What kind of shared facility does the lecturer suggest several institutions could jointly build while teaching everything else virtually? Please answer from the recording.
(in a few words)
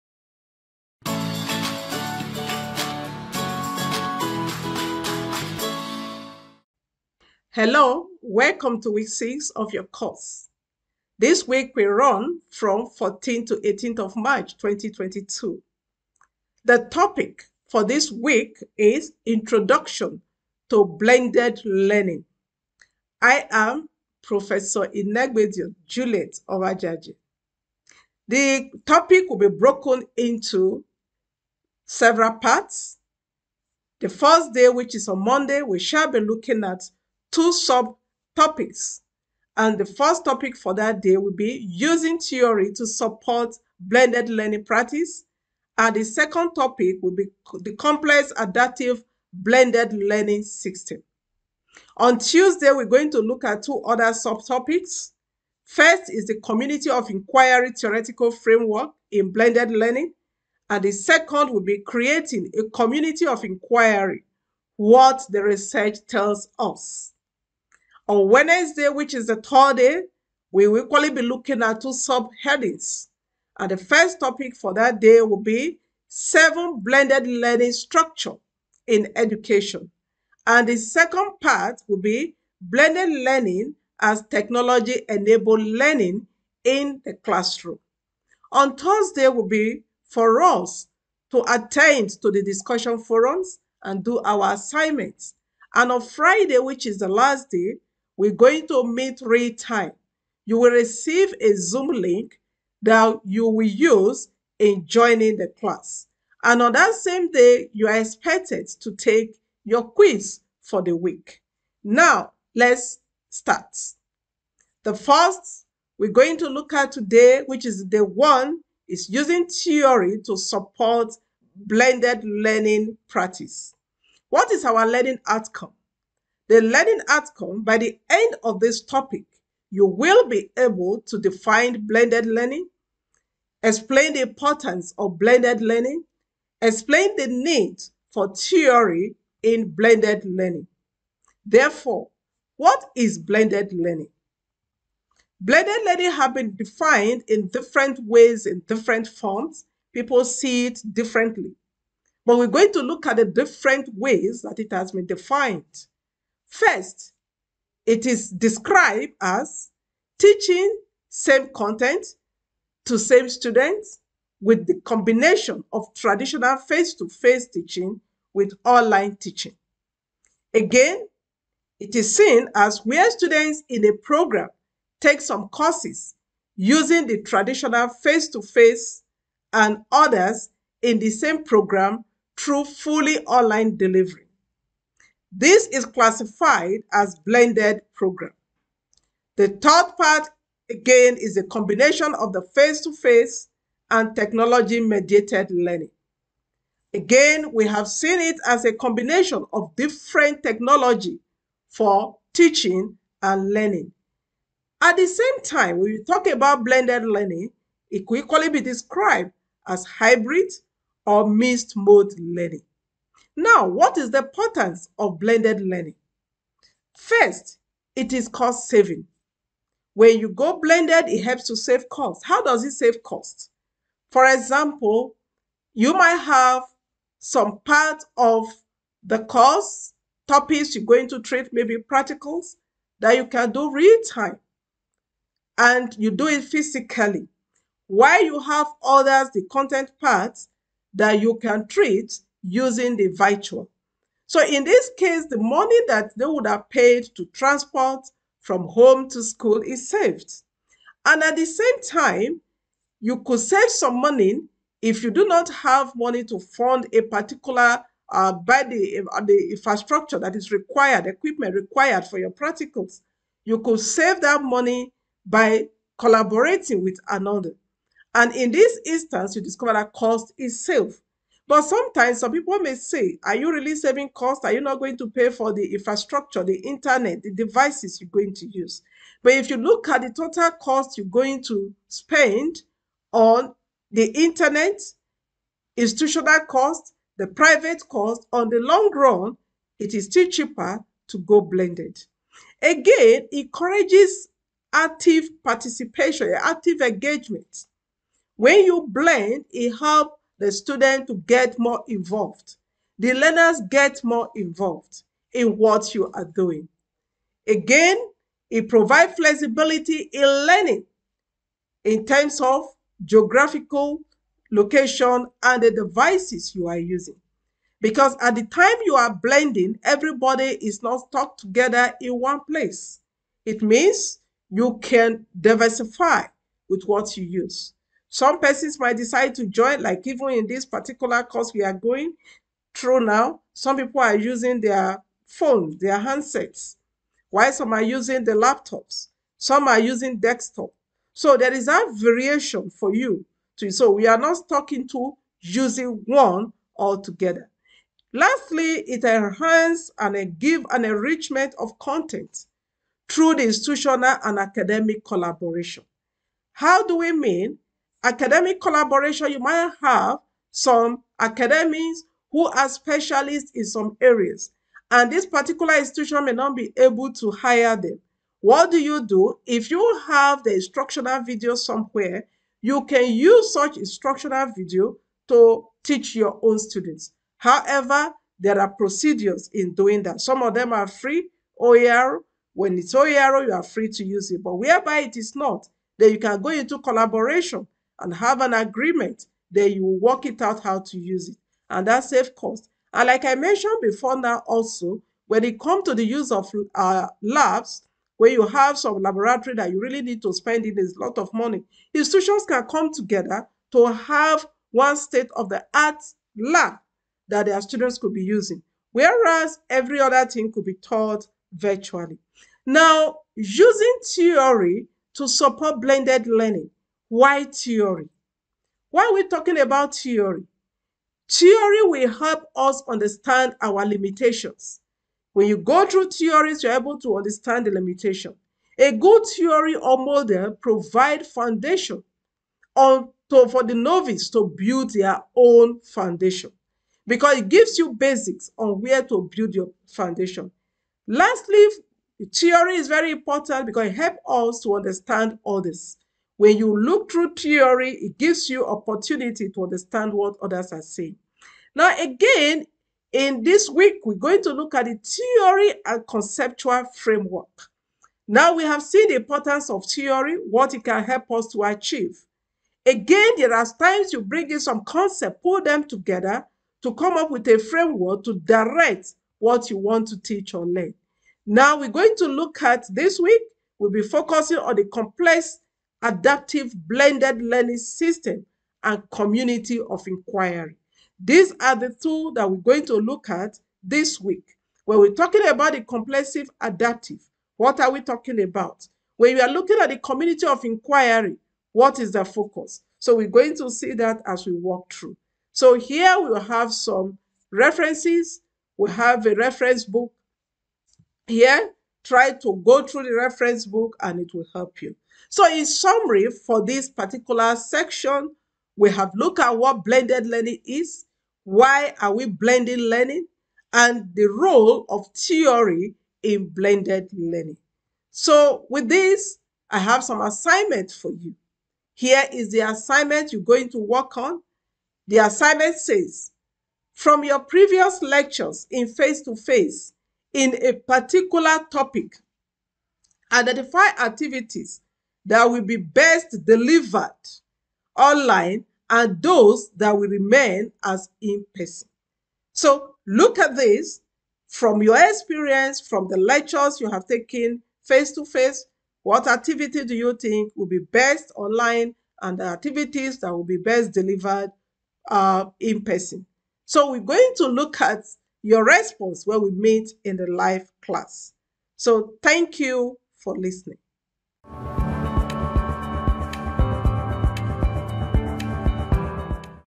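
State of the art lab.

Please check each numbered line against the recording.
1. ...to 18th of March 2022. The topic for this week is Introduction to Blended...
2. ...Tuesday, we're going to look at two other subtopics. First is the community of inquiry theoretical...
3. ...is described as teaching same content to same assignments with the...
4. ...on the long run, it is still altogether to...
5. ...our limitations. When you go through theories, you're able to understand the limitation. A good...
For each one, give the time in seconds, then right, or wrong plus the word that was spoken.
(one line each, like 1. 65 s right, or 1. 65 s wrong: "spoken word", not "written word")
1. 13 s right
2. 52 s right
3. 158 s wrong: "students", not "assignments"
4. 288 s wrong: "cheaper", not "altogether"
5. 423 s right.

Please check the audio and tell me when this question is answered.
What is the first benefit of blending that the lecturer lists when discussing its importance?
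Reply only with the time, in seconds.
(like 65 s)
218 s.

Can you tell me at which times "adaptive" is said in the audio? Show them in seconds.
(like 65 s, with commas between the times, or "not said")
48 s, 476 s, 486 s.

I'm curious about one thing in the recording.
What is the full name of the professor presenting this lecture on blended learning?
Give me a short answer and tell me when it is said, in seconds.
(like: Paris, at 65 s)
Inegbedion Juliet Ovajaji, at 24 s.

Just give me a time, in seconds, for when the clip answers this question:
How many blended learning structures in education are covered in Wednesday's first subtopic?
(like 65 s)
76 s.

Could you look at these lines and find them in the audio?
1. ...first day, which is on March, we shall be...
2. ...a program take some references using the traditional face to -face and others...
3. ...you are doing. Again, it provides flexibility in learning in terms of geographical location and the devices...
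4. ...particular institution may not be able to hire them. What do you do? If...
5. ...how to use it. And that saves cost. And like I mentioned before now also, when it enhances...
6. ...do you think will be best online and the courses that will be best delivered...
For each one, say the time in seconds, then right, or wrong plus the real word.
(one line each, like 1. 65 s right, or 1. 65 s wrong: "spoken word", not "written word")
1. 34 s wrong: "Monday", not "March"
2. 173 s wrong: "courses", not "references"
3. 305 s right
4. 365 s right
5. 390 s wrong: "comes", not "enhances"
6. 549 s wrong: "activities", not "courses".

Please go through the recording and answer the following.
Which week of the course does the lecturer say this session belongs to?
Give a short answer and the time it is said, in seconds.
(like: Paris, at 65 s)
6, at 8 s.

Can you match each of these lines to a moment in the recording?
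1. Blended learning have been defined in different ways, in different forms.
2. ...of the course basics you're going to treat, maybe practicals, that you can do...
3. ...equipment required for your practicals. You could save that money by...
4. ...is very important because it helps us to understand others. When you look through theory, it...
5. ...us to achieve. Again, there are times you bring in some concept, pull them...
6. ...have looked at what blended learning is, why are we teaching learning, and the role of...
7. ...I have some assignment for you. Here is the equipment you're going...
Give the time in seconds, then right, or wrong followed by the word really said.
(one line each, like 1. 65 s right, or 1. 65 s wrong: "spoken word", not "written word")
1. 145 s right
2. 228 s wrong: "topics", not "basics"
3. 261 s right
4. 442 s right
5. 461 s right
6. 508 s wrong: "blending", not "teaching"
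7. 519 s wrong: "assignment", not "equipment".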